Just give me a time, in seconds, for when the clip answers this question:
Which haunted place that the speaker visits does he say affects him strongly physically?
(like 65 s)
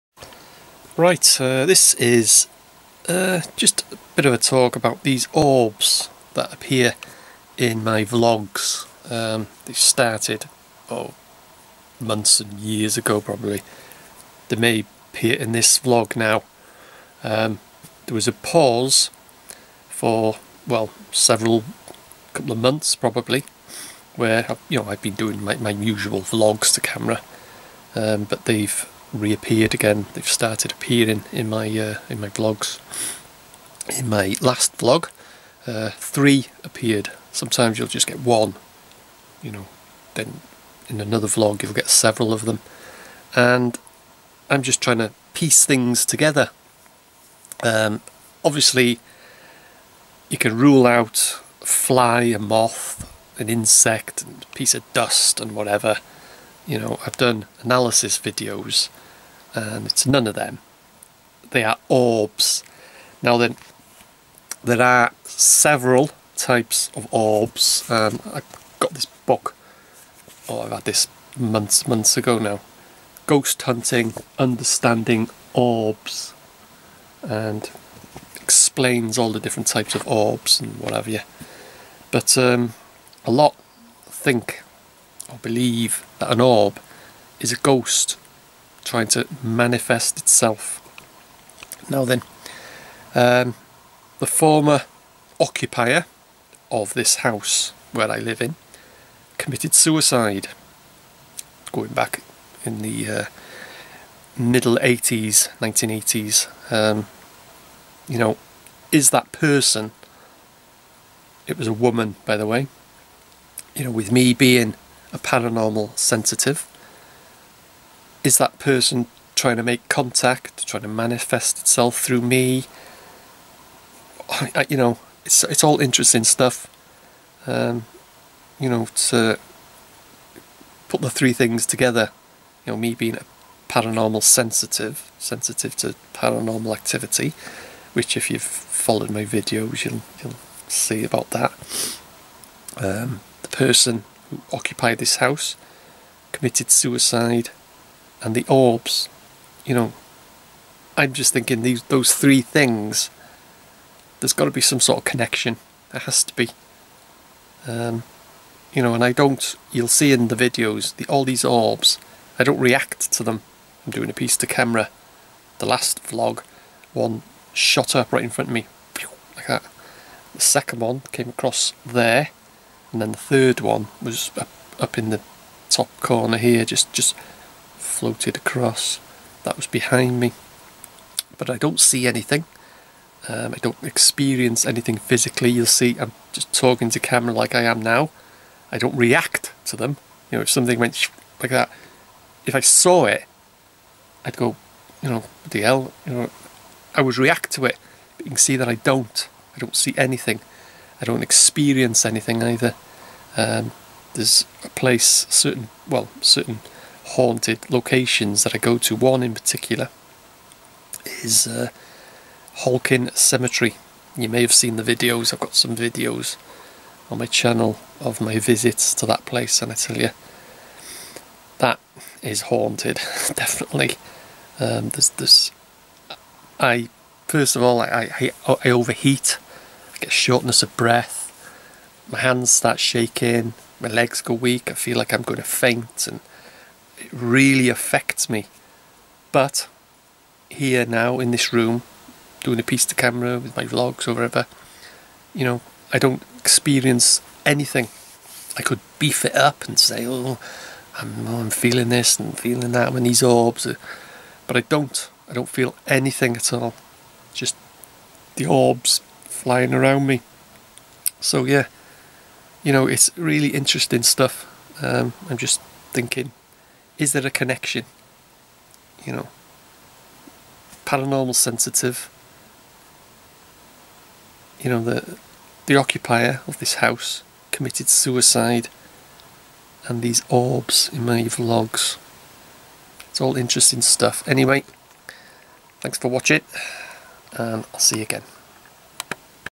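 212 s.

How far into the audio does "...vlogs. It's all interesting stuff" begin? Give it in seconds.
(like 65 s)
281 s.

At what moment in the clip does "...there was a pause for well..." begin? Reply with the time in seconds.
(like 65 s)
18 s.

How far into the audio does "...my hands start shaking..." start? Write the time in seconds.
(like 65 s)
232 s.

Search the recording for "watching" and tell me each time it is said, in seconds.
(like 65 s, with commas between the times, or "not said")
286 s.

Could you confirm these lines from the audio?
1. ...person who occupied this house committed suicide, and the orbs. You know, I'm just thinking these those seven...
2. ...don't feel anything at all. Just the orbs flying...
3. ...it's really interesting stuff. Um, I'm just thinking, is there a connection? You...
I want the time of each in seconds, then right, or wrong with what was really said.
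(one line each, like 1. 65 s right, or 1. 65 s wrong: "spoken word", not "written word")
1. 143 s wrong: "three", not "seven"
2. 255 s right
3. 262 s right.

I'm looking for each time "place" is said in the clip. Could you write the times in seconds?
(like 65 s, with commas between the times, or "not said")
204 s, 219 s.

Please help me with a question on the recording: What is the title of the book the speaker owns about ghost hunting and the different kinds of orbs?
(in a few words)
Understanding Orbs.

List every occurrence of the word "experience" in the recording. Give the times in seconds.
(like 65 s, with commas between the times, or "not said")
183 s, 201 s, 246 s.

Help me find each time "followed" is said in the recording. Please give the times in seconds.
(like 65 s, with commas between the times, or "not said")
138 s.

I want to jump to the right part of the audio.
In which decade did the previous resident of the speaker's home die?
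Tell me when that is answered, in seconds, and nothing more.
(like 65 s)
105 s.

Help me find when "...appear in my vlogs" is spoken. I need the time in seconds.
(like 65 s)
6 s.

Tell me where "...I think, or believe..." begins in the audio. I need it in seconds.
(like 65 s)
84 s.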